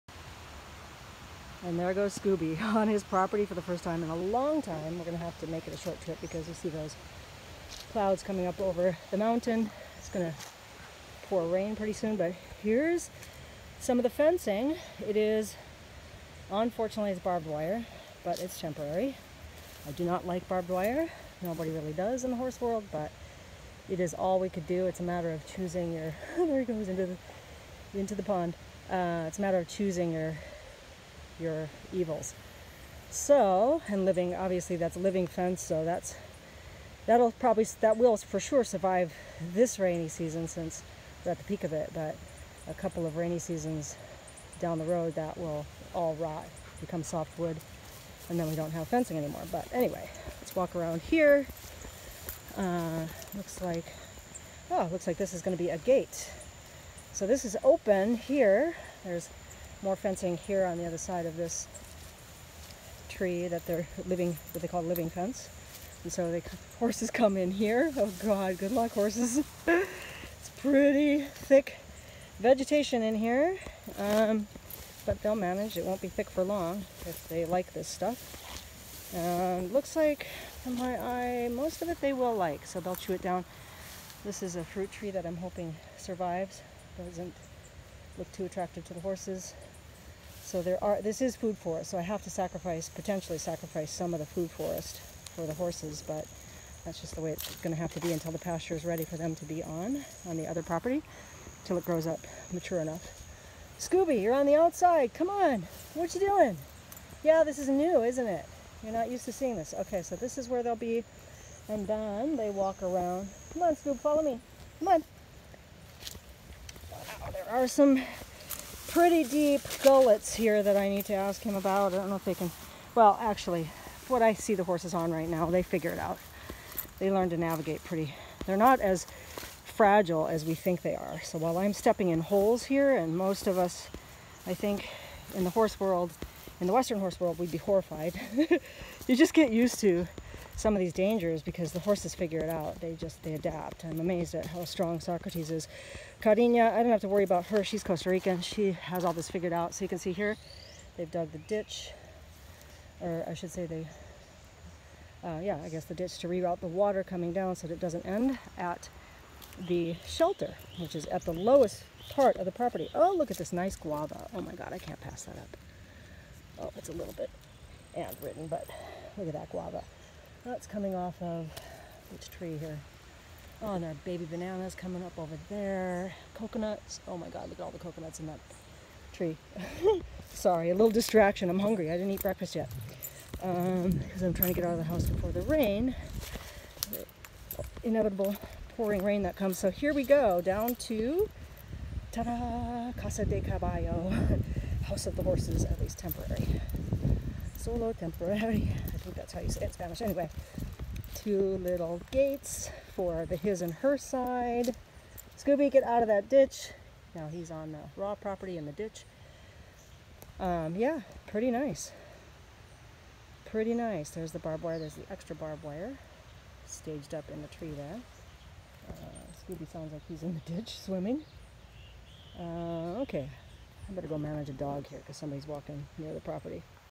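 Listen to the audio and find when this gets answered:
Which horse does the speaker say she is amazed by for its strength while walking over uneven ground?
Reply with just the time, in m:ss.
2:24.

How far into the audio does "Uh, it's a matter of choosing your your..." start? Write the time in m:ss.
0:28.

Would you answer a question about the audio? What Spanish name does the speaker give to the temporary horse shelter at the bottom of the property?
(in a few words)
Casa de Caballo.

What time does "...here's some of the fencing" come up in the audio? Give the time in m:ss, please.
0:12.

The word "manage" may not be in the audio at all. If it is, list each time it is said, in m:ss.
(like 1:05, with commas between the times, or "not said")
1:15, 3:44.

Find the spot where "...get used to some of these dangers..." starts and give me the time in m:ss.
2:19.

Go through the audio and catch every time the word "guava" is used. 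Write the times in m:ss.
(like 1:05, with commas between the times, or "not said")
2:43, 2:49.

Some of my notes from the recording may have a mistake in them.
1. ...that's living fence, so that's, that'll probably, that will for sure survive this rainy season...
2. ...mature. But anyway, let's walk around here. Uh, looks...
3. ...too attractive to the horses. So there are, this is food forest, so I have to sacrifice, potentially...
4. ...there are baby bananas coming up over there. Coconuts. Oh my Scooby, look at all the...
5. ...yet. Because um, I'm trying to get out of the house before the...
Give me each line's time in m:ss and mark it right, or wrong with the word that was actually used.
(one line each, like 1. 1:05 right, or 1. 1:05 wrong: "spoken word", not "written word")
1. 0:34 right
2. 0:49 wrong: "anymore", not "mature"
3. 1:28 right
4. 2:53 wrong: "God", not "Scooby"
5. 3:02 right.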